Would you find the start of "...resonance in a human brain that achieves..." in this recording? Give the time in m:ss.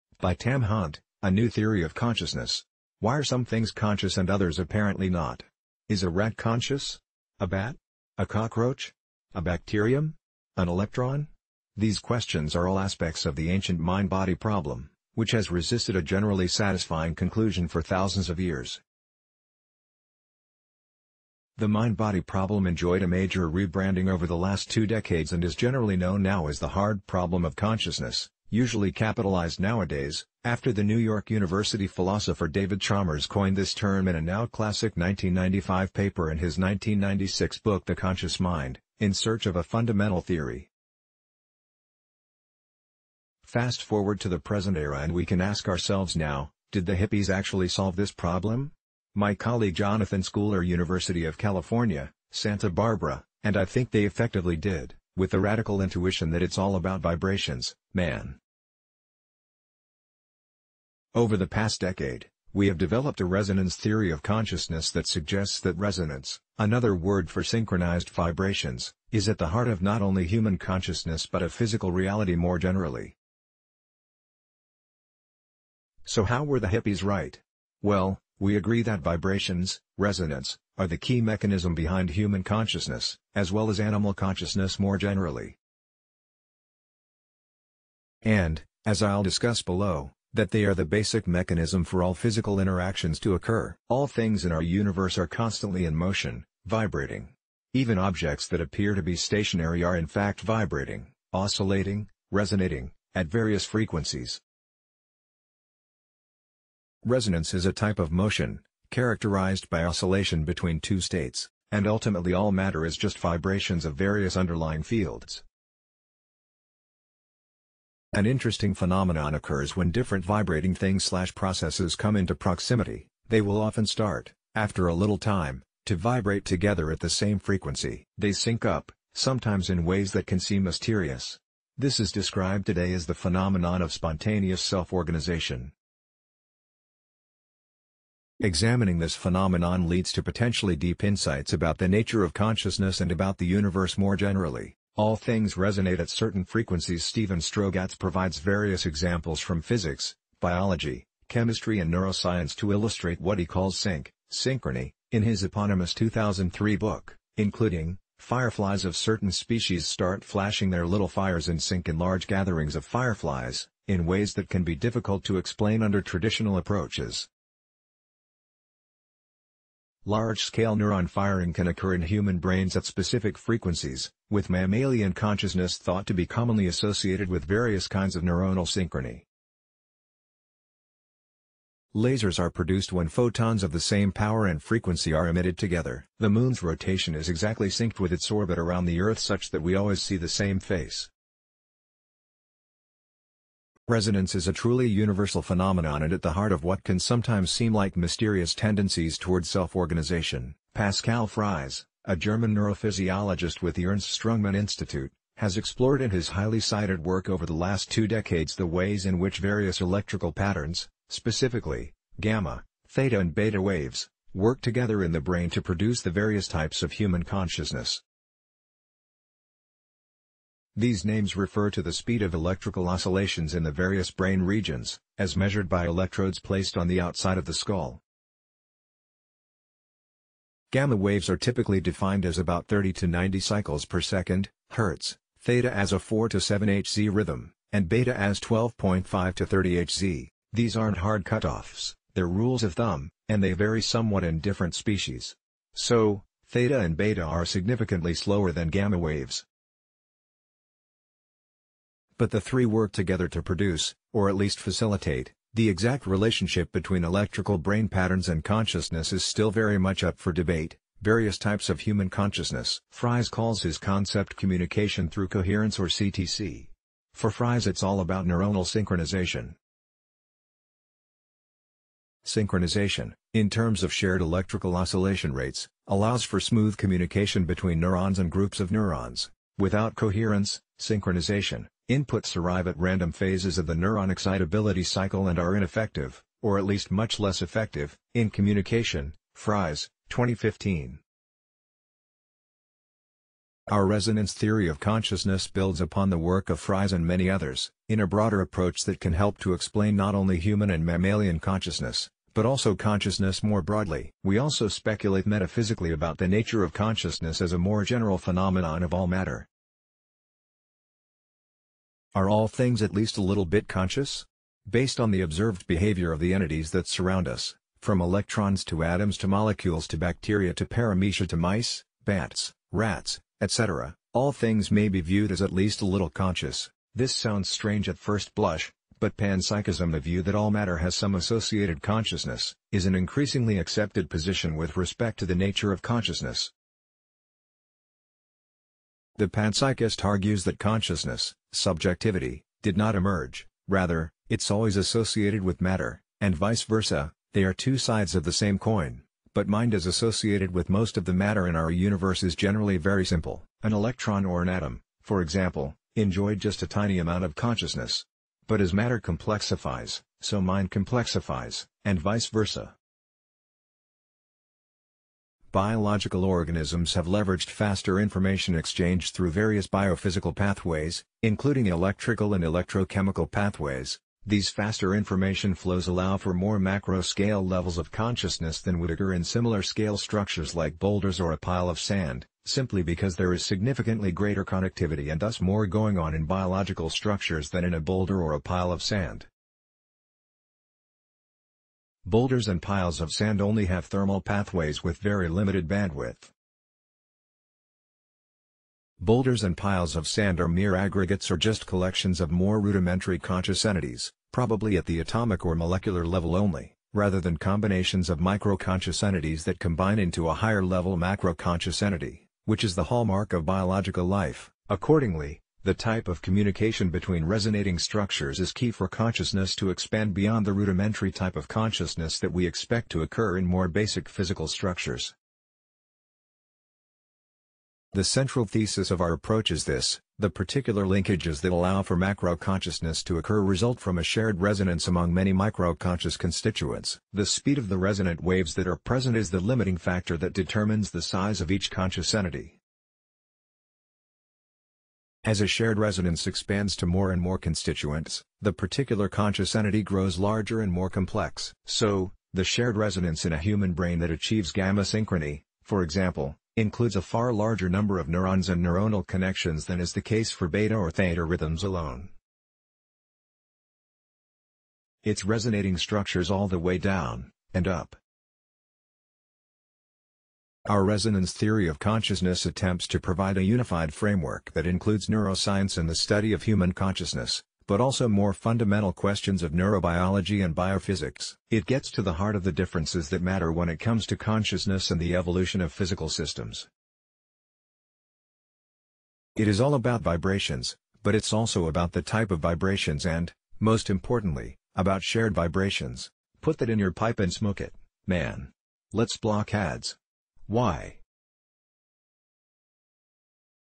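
7:32.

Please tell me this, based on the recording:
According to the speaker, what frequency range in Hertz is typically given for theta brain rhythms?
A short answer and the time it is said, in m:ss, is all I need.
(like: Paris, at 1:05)
4 to 7 Hz, at 3:55.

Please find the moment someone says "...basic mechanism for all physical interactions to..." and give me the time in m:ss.
1:30.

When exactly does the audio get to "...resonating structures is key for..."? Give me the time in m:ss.
6:57.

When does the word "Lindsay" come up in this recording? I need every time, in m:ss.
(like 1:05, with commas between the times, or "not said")
not said.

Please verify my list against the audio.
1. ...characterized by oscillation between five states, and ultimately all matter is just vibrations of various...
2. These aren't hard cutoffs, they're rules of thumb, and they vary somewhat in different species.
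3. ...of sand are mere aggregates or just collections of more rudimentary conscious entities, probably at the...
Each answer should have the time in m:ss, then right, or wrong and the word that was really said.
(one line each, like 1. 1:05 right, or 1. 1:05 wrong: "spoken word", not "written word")
1. 1:48 wrong: "two", not "five"
2. 4:00 right
3. 6:39 right.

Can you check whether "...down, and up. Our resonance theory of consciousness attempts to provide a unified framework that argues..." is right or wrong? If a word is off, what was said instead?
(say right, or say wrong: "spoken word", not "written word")
wrong: "includes", not "argues".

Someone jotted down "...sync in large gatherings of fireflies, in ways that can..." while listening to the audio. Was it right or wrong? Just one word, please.
right.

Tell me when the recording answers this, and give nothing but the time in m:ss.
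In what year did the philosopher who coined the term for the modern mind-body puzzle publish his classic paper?
0:34.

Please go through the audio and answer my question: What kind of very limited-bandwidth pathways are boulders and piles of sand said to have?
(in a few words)
Thermal pathways.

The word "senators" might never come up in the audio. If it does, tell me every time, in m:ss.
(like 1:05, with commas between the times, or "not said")
not said.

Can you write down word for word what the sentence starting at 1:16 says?
So how were the hippies right?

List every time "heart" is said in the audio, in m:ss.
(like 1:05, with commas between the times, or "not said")
1:09, 3:16, 8:02.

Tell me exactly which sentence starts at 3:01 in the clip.
Lasers are produced when photons of the same power and frequency are emitted together.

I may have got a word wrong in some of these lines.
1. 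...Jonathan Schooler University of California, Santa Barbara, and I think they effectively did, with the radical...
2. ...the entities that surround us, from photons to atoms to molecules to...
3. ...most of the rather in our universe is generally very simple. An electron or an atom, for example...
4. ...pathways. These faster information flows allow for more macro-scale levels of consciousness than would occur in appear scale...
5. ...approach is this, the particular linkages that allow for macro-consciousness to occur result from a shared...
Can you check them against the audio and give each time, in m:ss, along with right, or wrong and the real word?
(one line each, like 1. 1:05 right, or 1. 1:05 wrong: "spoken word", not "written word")
1. 0:49 right
2. 5:16 wrong: "electrons", not "photons"
3. 5:50 wrong: "matter", not "rather"
4. 6:13 wrong: "similar", not "appear"
5. 7:09 right.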